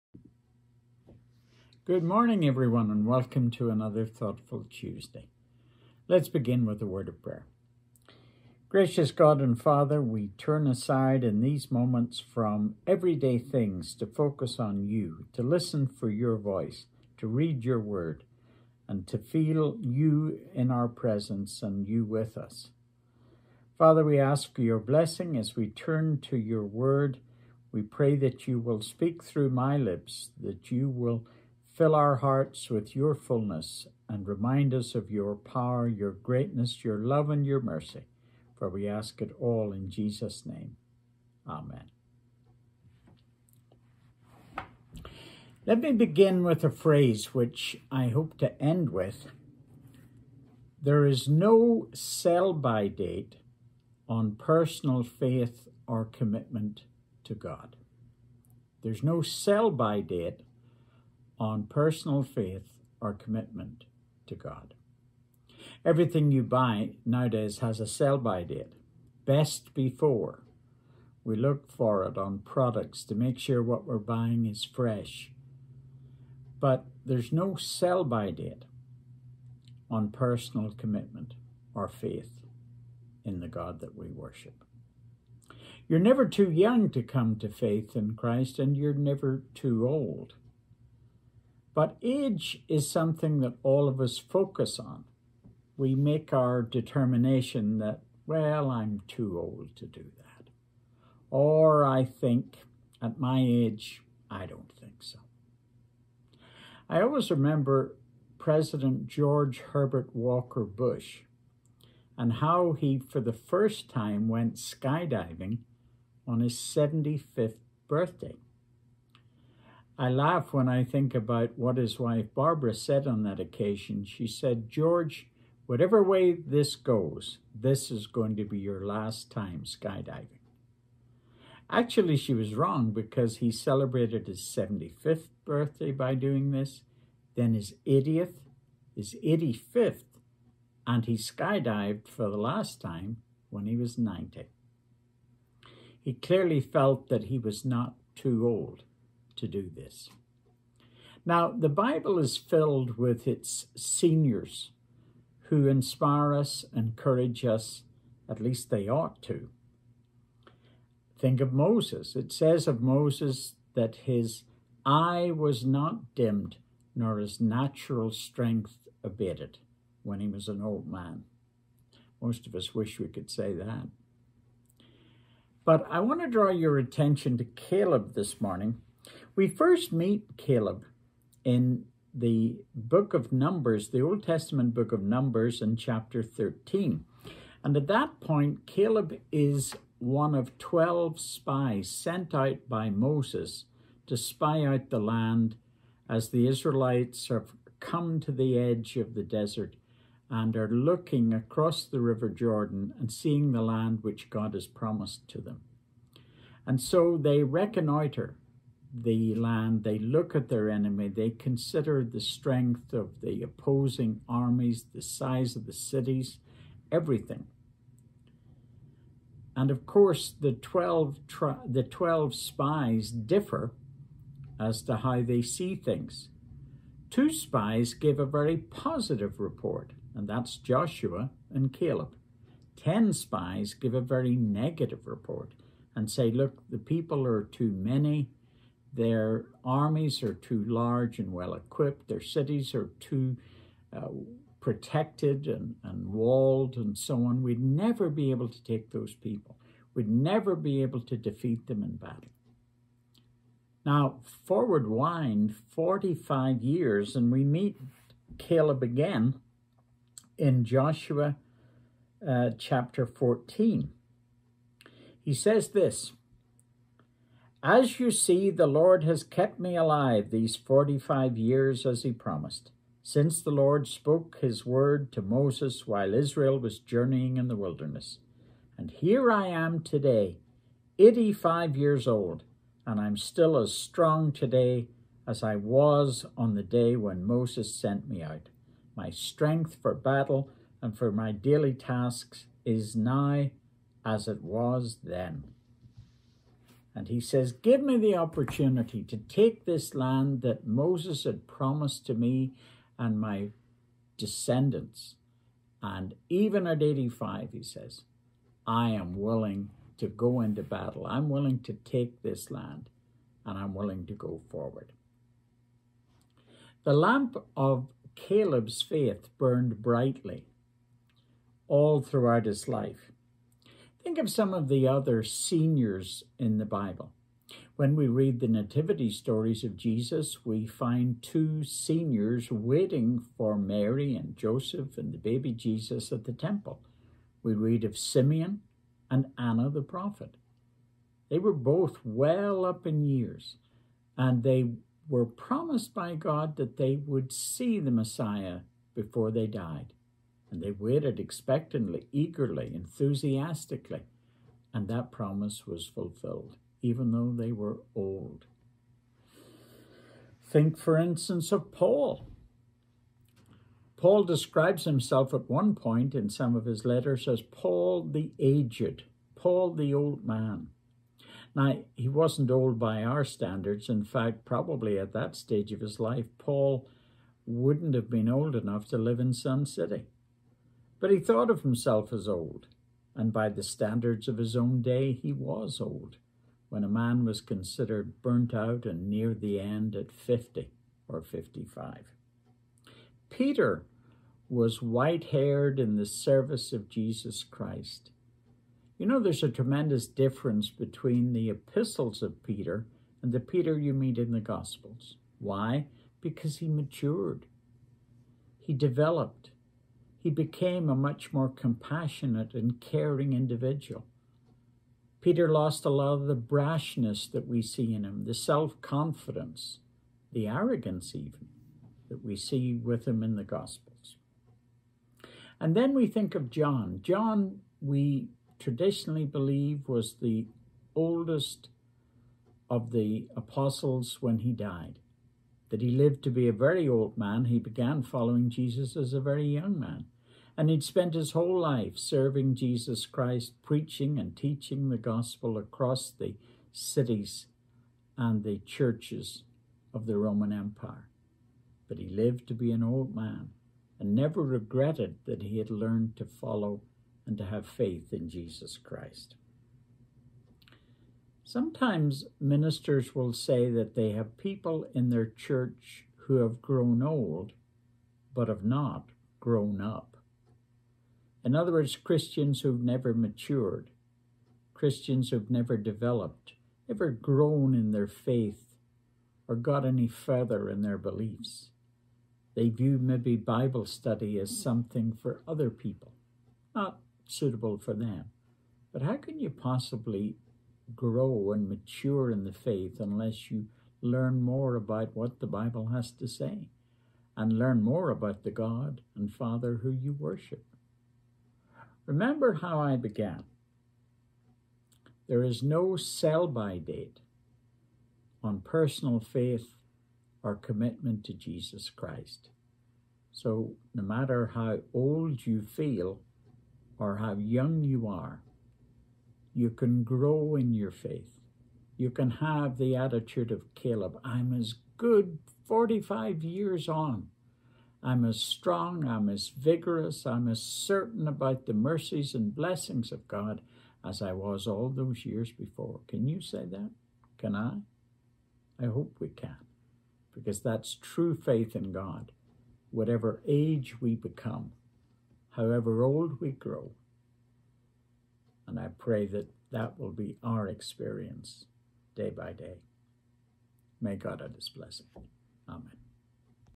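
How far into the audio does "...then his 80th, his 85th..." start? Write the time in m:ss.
2:17.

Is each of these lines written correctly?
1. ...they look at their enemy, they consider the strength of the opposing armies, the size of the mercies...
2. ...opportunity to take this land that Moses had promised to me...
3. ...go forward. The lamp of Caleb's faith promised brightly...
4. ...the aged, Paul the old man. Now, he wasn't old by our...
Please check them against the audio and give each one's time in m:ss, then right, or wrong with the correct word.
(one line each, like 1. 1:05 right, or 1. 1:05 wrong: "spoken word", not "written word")
1. 3:29 wrong: "cities", not "mercies"
2. 4:58 right
3. 5:14 wrong: "burned", not "promised"
4. 6:08 right.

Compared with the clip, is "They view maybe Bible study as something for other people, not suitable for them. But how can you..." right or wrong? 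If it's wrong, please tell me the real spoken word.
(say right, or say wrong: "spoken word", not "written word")
right.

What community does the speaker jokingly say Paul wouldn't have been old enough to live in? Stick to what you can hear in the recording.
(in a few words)
Sun City.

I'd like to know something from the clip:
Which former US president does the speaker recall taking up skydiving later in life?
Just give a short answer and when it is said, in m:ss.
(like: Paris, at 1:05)
George Herbert Walker Bush, at 1:49.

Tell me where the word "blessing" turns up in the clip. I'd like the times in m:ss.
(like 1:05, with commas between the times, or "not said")
0:24, 8:52, 9:14.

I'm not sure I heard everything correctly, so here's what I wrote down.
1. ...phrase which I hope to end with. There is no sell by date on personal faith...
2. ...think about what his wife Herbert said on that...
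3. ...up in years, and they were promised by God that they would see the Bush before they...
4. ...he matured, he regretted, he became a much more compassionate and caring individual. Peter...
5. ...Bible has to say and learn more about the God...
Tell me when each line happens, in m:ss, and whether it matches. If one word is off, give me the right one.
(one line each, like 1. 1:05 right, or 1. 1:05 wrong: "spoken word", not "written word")
1. 0:46 right
2. 2:00 wrong: "Barbara", not "Herbert"
3. 5:42 wrong: "Messiah", not "Bush"
4. 6:46 wrong: "developed", not "regretted"
5. 8:15 right.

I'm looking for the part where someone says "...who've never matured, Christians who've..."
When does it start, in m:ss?
7:52.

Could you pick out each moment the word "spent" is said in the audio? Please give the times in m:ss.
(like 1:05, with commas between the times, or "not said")
7:20.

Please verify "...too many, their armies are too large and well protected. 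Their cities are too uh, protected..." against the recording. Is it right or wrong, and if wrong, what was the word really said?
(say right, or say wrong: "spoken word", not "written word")
wrong: "equipped", not "protected".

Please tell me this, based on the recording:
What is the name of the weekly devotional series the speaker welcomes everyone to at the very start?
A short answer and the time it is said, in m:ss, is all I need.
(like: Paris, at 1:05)
Thoughtful Tuesday, at 0:04.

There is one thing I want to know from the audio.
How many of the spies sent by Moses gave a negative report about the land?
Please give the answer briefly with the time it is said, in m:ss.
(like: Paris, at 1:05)
10, at 3:52.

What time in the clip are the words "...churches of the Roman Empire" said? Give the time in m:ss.
7:28.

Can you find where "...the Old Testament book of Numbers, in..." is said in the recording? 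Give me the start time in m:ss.
3:03.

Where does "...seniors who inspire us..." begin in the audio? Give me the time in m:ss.
2:33.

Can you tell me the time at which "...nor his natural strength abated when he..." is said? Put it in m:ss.
2:46.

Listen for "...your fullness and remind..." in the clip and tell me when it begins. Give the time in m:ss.
0:32.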